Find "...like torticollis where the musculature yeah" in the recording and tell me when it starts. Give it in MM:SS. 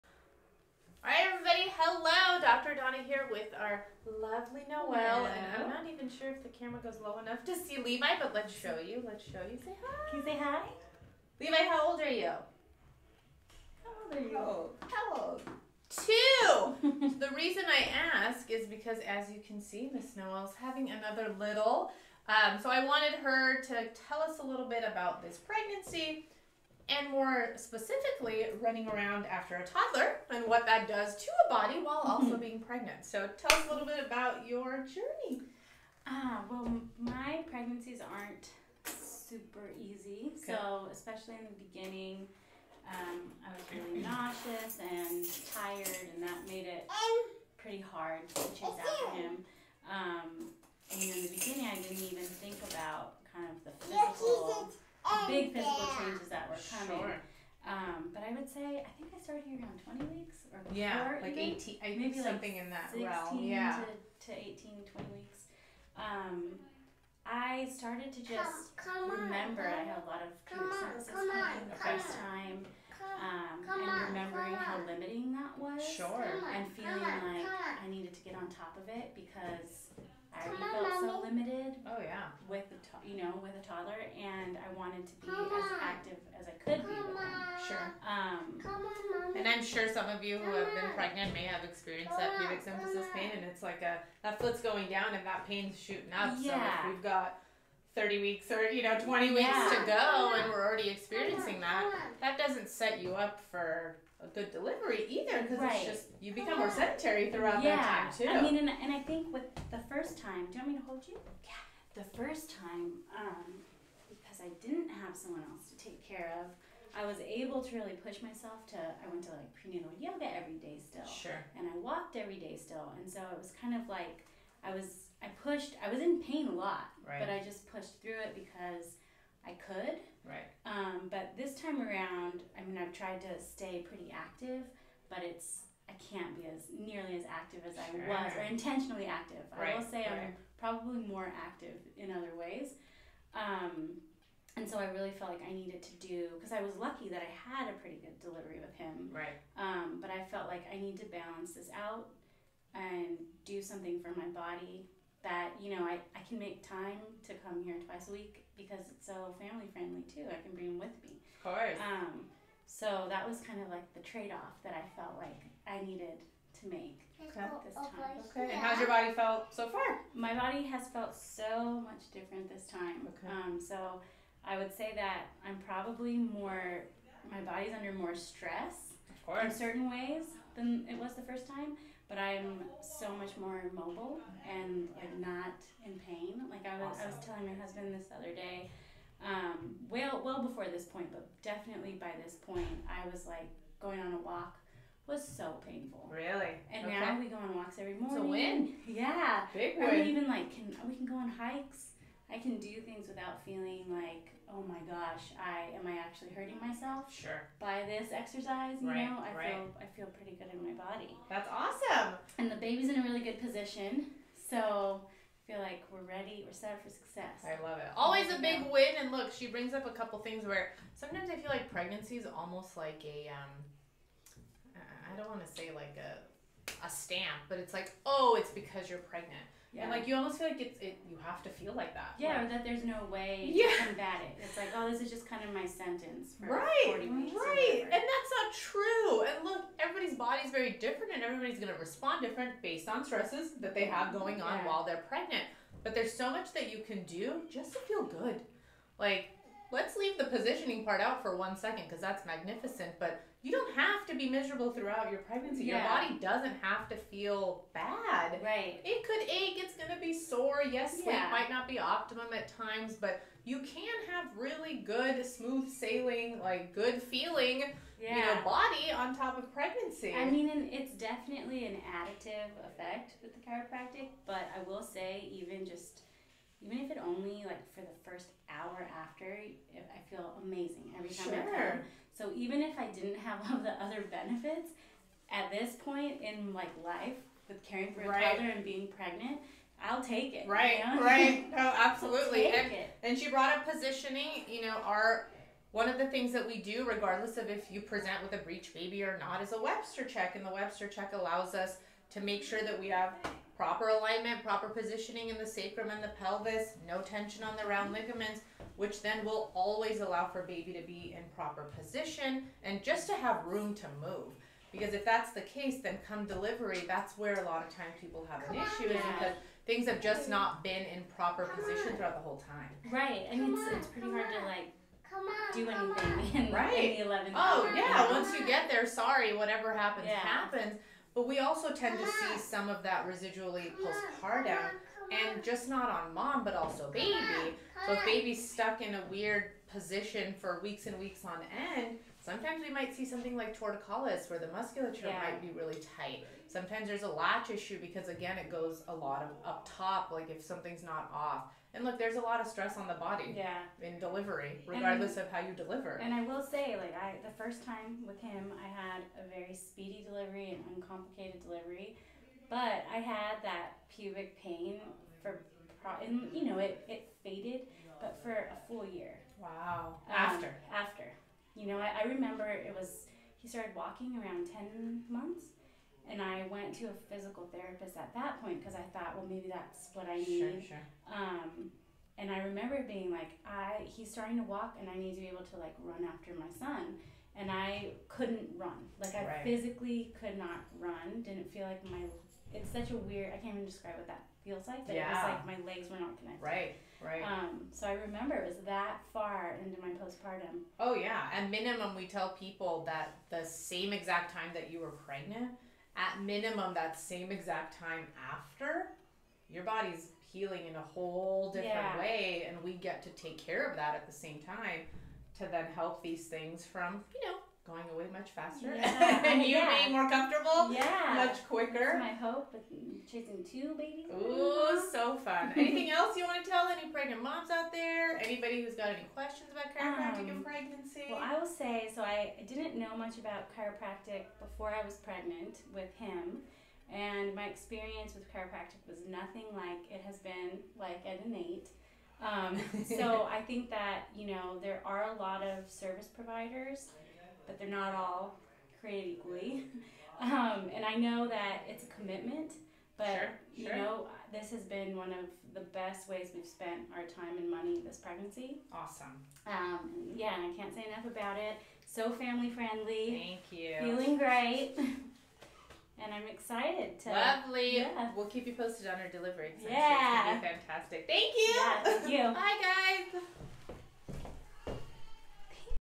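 05:43.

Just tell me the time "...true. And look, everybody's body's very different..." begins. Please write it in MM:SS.
03:58.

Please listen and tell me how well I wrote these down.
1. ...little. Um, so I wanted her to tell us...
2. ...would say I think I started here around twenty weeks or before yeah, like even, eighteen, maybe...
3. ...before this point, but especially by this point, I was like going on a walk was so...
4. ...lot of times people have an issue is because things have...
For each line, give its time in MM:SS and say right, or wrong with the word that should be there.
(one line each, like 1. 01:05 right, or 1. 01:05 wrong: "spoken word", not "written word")
1. 00:21 right
2. 00:58 right
3. 03:10 wrong: "definitely", not "especially"
4. 05:17 right.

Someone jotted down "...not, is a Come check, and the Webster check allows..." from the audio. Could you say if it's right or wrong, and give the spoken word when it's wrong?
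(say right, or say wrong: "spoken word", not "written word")
wrong: "Webster", not "Come".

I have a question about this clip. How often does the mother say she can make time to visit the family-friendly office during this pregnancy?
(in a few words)
twice a week.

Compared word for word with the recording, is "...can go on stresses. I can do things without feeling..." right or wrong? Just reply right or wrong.
wrong.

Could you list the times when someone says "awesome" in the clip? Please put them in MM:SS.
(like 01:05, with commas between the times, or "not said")
03:06, 03:31, 07:38.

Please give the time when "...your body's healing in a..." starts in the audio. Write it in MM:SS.
06:49.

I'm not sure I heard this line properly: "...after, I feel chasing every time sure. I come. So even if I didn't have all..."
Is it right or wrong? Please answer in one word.
wrong.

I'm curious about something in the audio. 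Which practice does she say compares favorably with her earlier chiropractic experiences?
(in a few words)
Innate.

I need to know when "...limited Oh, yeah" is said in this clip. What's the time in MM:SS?
01:21.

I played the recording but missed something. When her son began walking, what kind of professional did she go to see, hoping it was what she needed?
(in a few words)
physical therapist.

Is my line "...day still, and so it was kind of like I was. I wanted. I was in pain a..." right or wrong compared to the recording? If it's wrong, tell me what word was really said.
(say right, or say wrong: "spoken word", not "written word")
wrong: "pushed", not "wanted".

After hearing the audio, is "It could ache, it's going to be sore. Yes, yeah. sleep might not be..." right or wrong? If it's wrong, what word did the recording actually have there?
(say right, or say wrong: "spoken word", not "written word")
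right.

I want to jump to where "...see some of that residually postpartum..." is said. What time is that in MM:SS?
05:32.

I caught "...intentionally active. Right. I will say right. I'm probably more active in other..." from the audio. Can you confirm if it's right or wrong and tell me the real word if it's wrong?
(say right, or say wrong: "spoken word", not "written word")
right.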